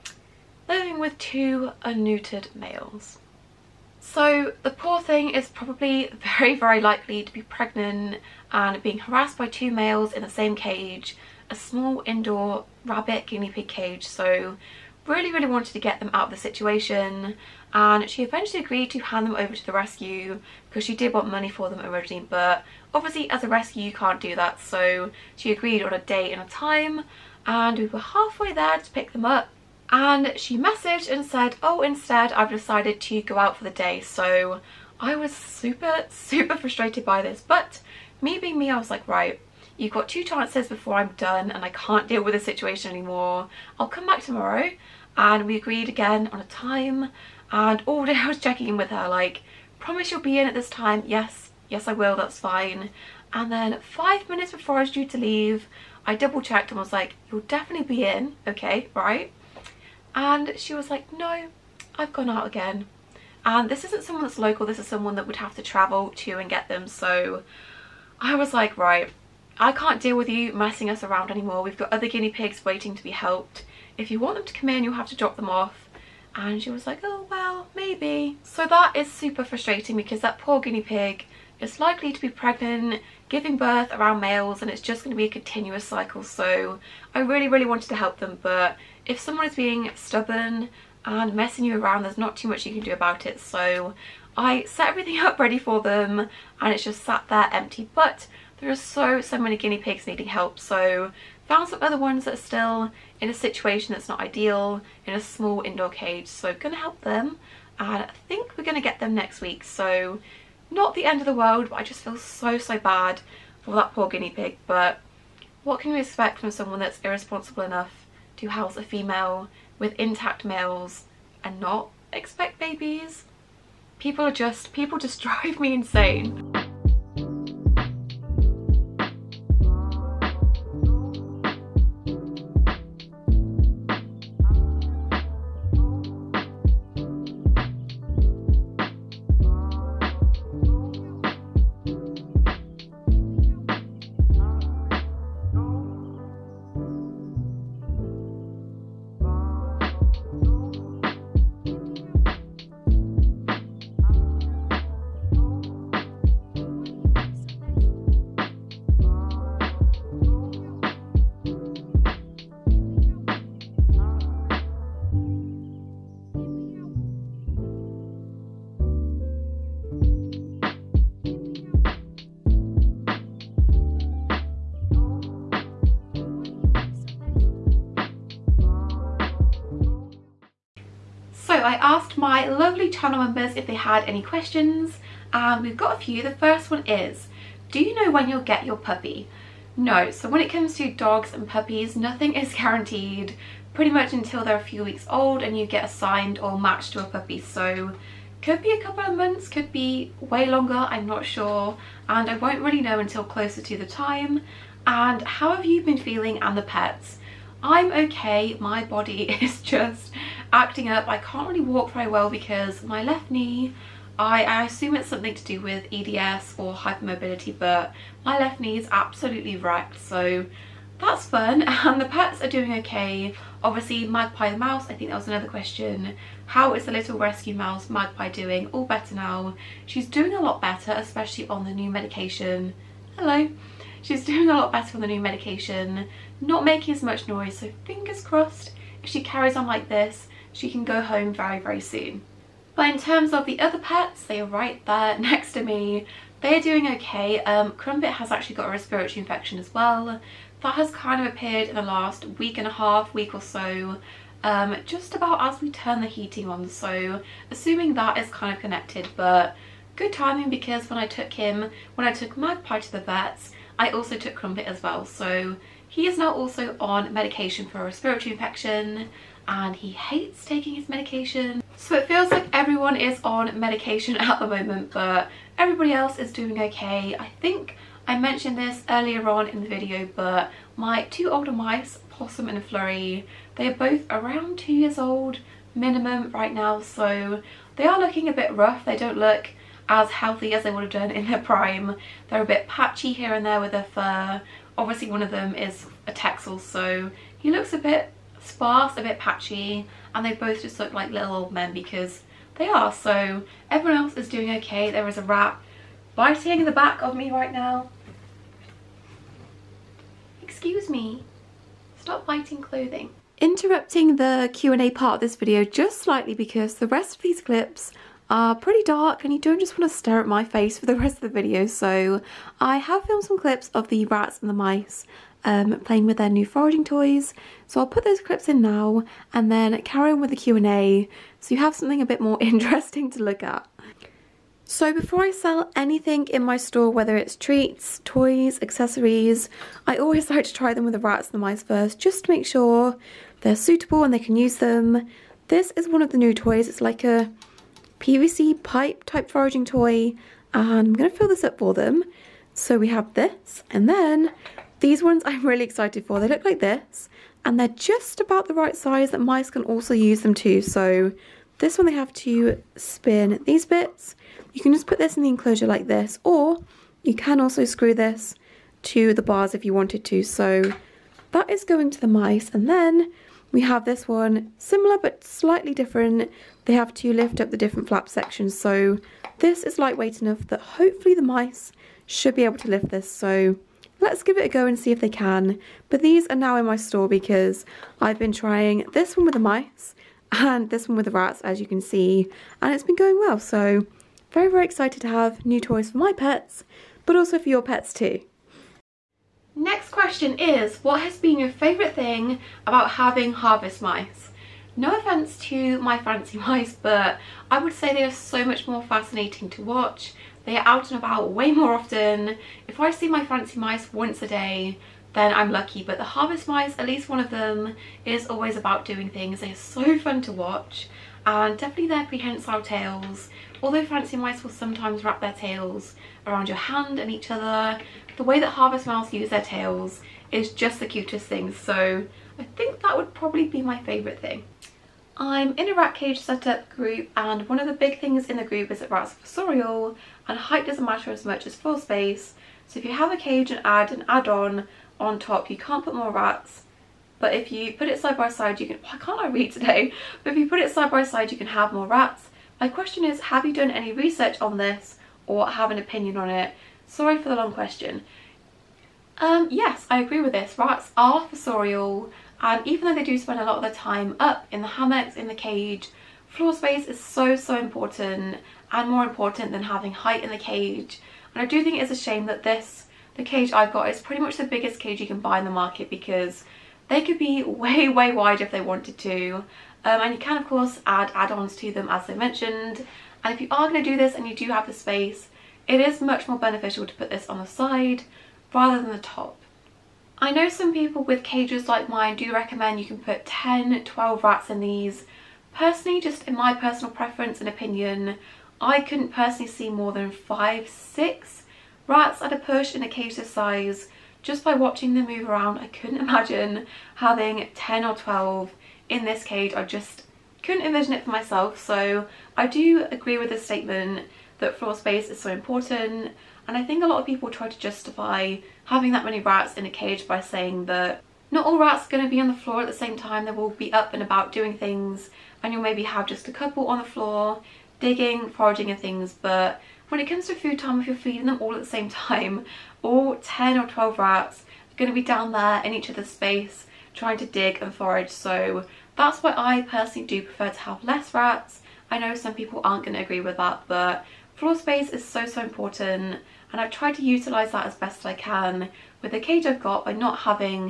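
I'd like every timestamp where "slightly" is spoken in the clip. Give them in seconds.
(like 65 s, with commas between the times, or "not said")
315 s, 375 s.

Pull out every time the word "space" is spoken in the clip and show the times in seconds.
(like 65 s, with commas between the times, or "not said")
441 s, 466 s, 484 s, 514 s, 536 s, 544 s.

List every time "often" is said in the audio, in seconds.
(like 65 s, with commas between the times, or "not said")
411 s.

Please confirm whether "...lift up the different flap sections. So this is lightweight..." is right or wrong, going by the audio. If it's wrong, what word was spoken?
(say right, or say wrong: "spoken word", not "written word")
right.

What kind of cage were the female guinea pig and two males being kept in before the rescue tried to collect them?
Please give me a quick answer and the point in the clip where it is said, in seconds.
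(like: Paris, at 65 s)
small indoor rabbit guinea pig cage, at 11 s.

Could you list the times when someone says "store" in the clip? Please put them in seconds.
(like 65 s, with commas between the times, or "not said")
336 s, 386 s.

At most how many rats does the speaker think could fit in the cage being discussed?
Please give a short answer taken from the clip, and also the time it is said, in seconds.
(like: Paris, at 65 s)
5 or 6, at 500 s.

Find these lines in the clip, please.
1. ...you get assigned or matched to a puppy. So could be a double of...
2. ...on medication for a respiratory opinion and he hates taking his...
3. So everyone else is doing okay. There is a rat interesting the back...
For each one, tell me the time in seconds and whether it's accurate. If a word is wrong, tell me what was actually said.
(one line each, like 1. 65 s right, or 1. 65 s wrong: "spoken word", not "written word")
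1. 195 s wrong: "couple", not "double"
2. 266 s wrong: "infection", not "opinion"
3. 302 s wrong: "biting", not "interesting".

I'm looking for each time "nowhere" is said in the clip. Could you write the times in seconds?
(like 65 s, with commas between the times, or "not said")
not said.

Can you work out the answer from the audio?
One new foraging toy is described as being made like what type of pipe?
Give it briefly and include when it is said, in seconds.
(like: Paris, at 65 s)
PVC, at 347 s.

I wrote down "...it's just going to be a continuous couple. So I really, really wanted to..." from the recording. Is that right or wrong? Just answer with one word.
wrong.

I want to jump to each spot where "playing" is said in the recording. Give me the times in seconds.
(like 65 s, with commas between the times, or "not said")
325 s.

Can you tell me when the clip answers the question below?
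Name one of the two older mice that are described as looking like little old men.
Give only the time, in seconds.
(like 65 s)
282 s.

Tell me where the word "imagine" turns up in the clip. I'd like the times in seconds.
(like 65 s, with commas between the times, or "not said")
505 s.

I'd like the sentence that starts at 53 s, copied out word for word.
And then five minutes before I was due to leave, I double checked and was like, you'll definitely be in, okay, right?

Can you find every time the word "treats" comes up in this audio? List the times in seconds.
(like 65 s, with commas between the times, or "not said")
337 s.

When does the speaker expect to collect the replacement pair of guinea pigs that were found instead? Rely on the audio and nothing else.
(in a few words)
next week.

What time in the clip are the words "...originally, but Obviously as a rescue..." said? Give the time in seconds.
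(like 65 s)
21 s.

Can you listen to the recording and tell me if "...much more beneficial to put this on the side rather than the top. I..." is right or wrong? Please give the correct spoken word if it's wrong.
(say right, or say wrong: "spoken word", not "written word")
right.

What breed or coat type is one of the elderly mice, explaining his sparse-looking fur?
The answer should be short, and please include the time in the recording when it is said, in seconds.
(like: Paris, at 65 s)
Texel, at 296 s.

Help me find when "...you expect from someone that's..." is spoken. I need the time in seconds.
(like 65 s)
115 s.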